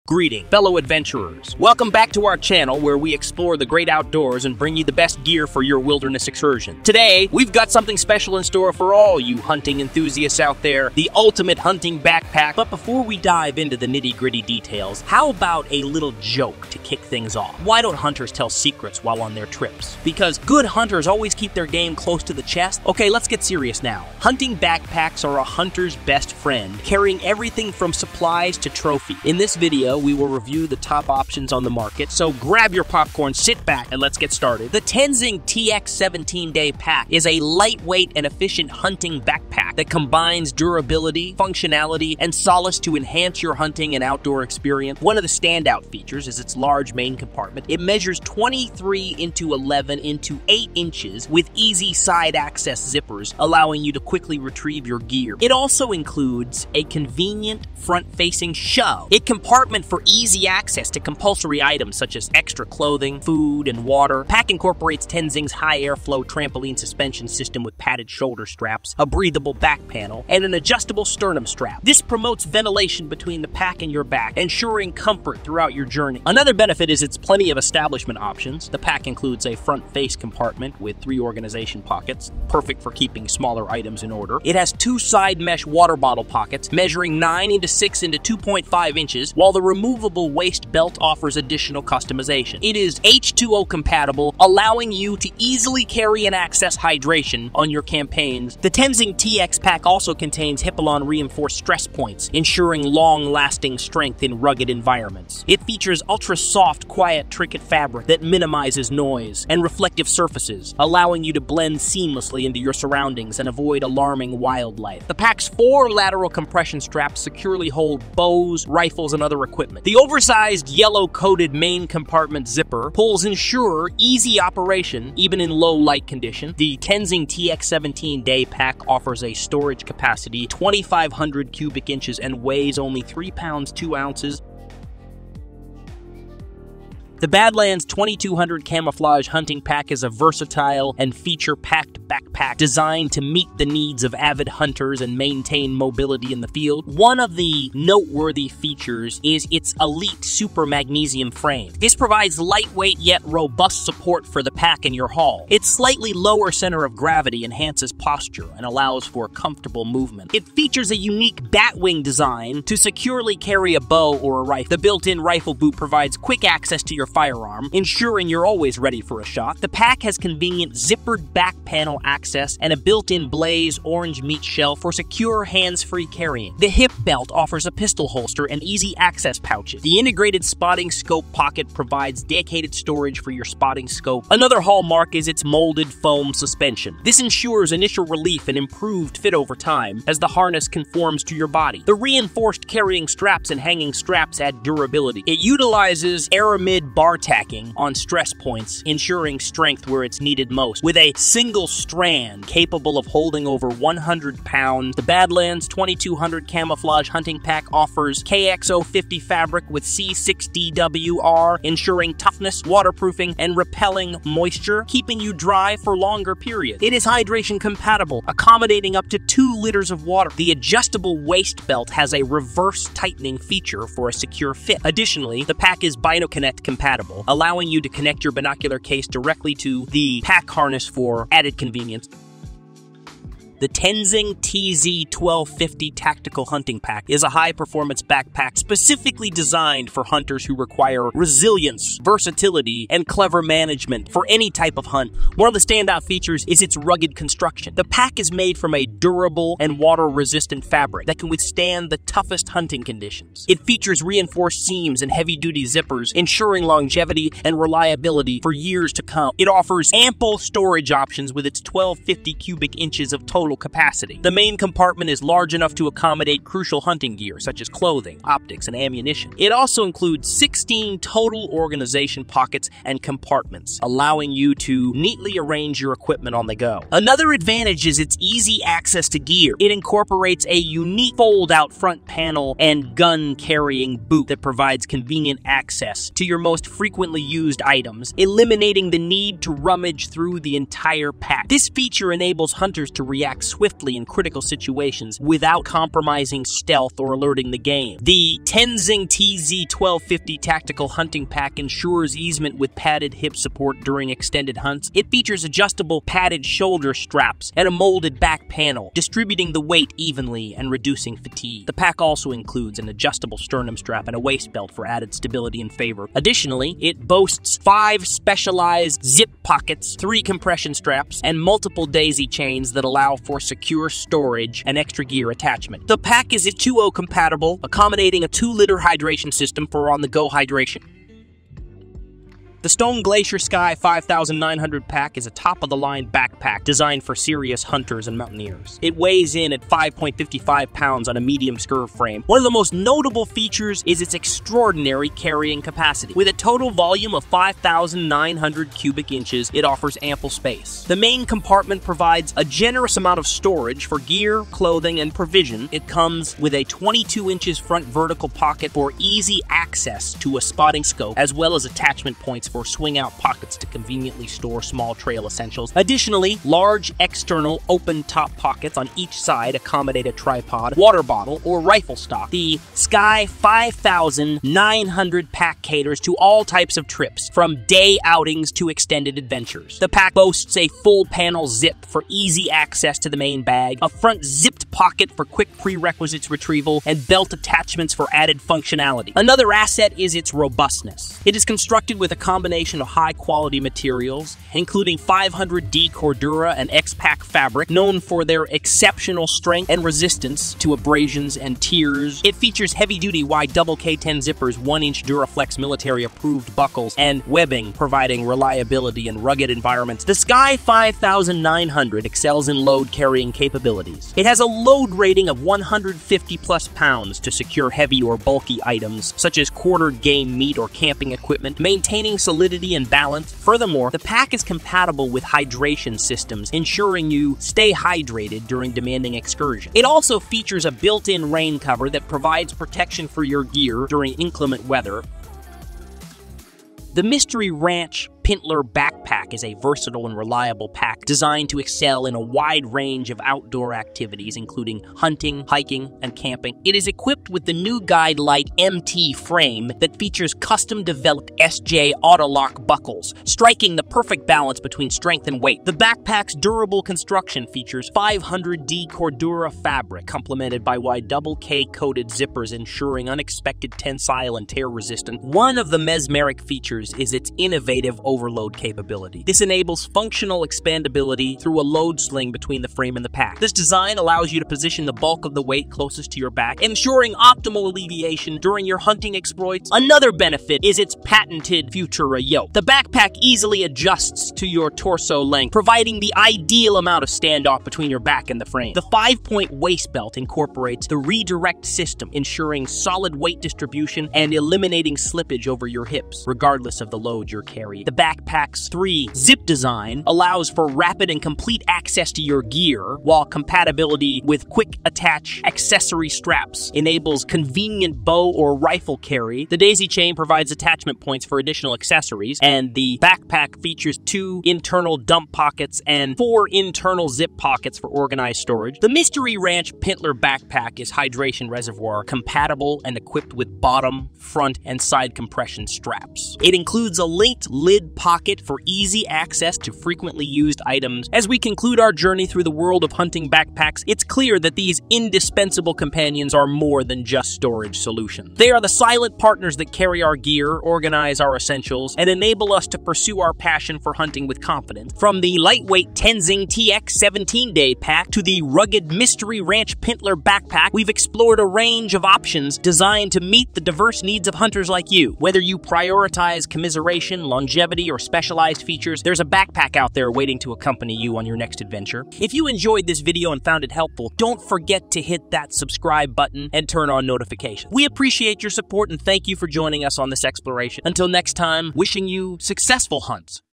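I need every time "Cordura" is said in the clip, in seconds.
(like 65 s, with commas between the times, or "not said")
395 s, 458 s.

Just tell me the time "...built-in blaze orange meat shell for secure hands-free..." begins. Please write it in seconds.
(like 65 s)
172 s.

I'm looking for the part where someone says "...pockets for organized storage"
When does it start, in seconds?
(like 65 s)
517 s.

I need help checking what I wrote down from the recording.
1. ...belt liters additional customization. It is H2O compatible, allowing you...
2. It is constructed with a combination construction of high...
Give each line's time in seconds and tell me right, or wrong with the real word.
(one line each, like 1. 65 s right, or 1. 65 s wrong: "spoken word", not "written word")
1. 90 s wrong: "offers", not "liters"
2. 391 s wrong: "combination", not "construction".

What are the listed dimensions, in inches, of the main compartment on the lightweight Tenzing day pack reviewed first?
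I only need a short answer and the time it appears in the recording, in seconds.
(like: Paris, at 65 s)
23 x 11 x 8 inches, at 48 s.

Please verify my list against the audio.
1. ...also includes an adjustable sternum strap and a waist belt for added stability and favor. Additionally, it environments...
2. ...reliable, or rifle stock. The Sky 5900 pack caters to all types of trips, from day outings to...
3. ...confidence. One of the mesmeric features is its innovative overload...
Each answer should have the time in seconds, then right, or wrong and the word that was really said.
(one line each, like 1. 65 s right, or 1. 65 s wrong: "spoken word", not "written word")
1. 312 s wrong: "boasts", not "environments"
2. 371 s wrong: "bottle", not "reliable"
3. 464 s wrong: "resistance", not "confidence".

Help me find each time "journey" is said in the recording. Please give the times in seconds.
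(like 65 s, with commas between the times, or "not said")
75 s, 531 s.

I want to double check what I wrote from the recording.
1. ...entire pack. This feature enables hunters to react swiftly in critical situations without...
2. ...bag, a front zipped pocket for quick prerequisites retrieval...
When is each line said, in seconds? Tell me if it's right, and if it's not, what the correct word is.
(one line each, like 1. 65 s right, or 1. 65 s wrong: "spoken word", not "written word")
1. 290 s right
2. 383 s right.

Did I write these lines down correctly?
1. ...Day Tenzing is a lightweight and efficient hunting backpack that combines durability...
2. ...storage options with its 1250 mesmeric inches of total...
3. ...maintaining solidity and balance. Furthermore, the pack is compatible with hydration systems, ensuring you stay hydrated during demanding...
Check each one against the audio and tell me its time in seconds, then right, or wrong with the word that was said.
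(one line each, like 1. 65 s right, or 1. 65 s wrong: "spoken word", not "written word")
1. 36 s wrong: "Pack", not "Tenzing"
2. 260 s wrong: "cubic", not "mesmeric"
3. 421 s right.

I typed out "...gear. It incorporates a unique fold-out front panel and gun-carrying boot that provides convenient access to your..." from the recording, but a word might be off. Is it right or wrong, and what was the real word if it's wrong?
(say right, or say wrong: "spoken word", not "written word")
right.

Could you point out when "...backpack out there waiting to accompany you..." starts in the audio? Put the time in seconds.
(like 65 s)
559 s.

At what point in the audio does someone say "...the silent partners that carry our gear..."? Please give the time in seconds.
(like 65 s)
538 s.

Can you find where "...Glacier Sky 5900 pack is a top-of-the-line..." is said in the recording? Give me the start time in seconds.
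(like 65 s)
333 s.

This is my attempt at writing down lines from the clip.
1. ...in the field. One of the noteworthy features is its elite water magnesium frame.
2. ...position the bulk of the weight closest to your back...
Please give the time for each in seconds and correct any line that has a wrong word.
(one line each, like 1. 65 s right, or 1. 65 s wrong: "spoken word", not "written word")
1. 146 s wrong: "super", not "water"
2. 474 s right.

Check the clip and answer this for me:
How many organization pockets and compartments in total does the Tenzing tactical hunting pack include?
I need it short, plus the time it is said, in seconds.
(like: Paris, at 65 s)
16, at 270 s.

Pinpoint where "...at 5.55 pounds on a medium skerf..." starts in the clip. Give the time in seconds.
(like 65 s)
339 s.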